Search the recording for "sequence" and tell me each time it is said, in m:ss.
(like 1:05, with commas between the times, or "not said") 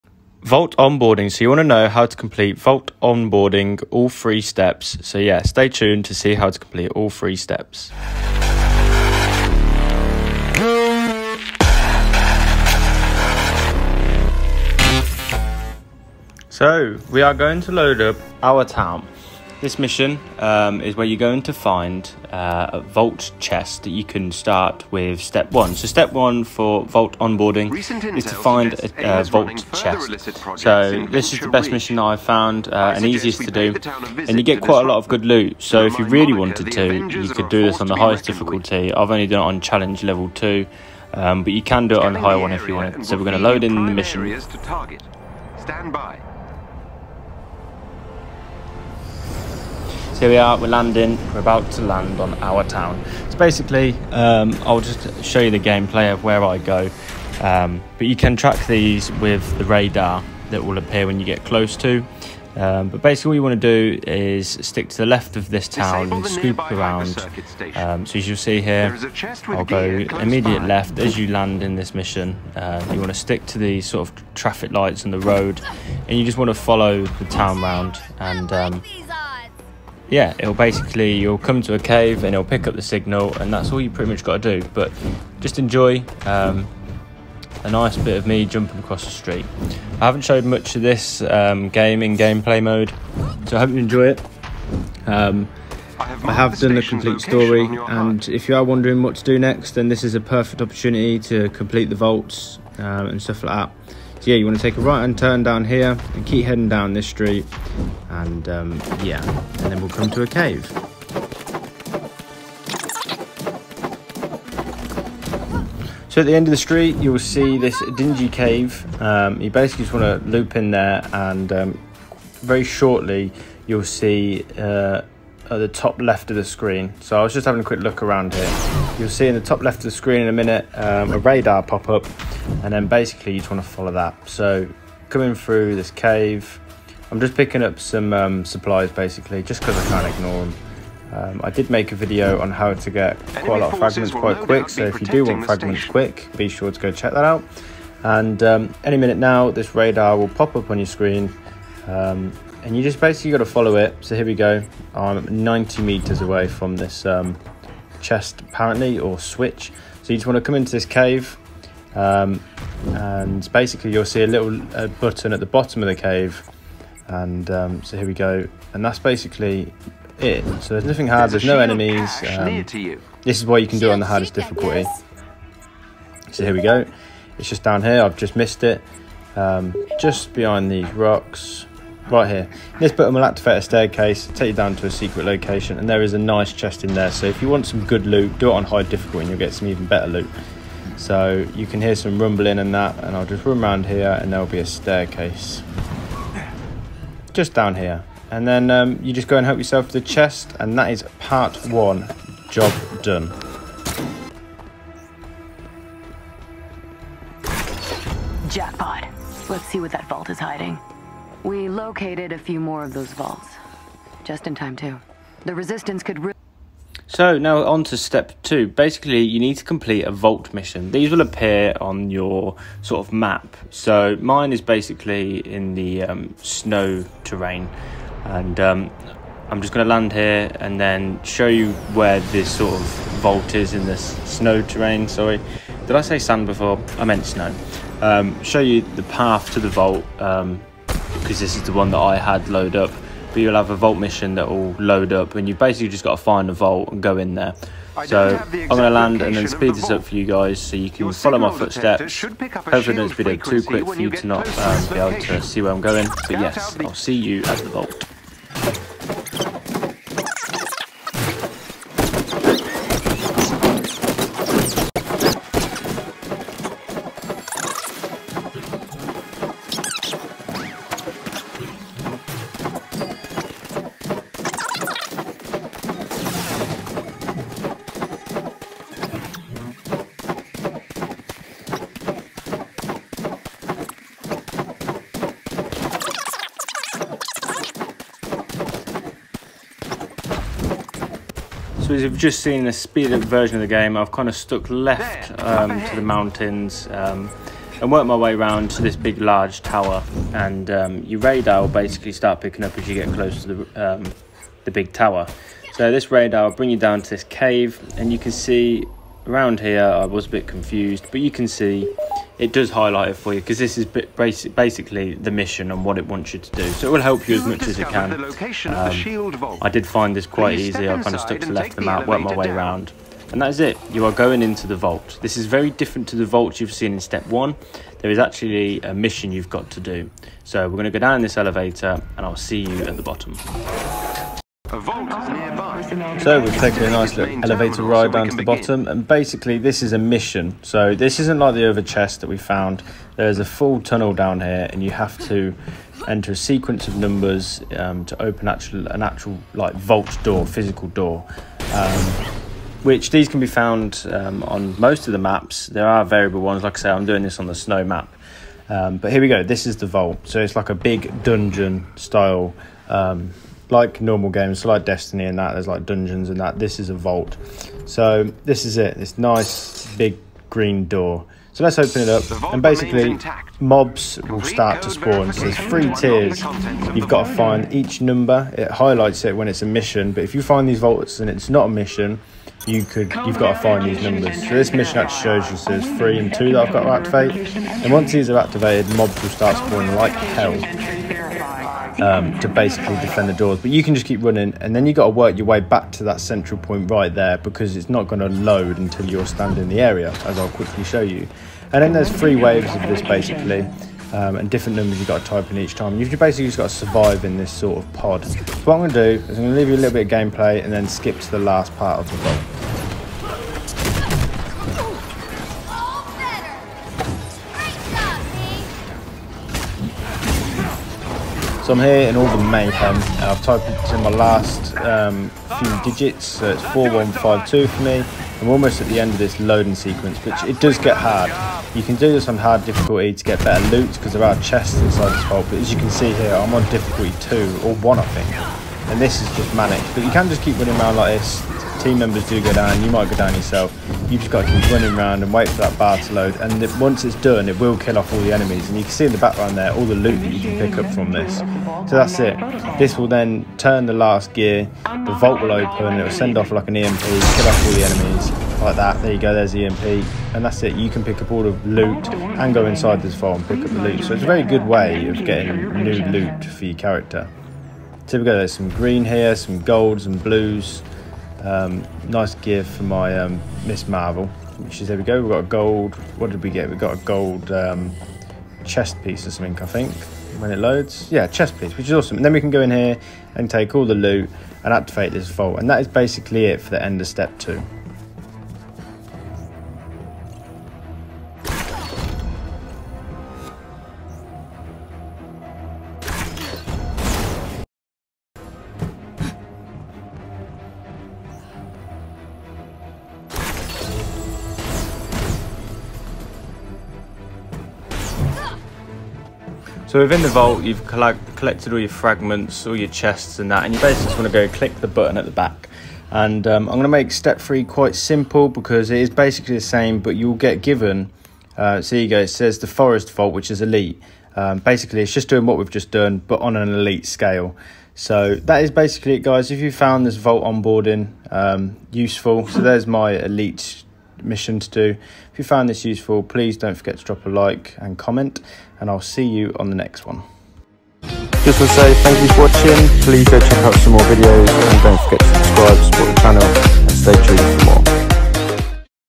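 5:46, 7:09.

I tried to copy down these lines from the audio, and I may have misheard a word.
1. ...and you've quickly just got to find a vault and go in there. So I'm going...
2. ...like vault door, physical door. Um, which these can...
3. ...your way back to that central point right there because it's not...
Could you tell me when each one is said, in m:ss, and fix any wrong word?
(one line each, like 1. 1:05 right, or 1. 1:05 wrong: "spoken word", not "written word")
1. 4:05 wrong: "basically", not "quickly"
2. 5:49 right
3. 6:35 right.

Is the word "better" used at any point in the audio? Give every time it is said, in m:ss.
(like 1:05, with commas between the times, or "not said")
3:09, 7:13.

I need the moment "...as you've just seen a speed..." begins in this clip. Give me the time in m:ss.
4:51.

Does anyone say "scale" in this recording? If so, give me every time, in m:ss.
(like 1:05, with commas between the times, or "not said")
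8:47.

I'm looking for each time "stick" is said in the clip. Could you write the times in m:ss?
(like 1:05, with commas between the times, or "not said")
1:04, 1:13.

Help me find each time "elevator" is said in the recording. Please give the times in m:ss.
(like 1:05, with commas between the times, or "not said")
5:31, 5:37.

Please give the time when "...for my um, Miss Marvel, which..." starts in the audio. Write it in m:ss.
7:52.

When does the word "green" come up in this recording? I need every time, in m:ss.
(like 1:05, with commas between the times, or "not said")
6:10, 7:48.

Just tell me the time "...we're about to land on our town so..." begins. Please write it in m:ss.
0:51.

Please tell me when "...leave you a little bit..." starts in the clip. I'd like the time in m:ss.
6:49.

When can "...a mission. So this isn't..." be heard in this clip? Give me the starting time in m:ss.
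5:39.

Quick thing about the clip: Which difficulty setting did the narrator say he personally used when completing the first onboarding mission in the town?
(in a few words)
Challenge level 2.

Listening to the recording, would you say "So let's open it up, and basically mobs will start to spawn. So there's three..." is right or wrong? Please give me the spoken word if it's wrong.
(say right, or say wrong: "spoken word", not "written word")
right.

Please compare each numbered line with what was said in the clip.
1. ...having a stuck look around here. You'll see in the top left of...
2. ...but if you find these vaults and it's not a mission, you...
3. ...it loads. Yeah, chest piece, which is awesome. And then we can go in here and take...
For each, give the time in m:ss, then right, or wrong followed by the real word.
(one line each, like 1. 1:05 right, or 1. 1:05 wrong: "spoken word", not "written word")
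1. 2:07 wrong: "quick", not "stuck"
2. 6:20 right
3. 8:00 right.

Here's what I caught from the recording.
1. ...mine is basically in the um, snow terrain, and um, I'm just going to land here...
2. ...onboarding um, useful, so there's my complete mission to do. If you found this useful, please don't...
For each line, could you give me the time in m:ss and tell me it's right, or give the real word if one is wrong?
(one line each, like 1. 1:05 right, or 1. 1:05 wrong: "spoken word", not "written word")
1. 3:44 right
2. 8:50 wrong: "elite", not "complete".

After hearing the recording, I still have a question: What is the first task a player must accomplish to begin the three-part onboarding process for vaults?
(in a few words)
Find a Vault chest.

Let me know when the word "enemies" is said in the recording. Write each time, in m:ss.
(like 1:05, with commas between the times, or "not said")
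2:51, 7:28, 7:37.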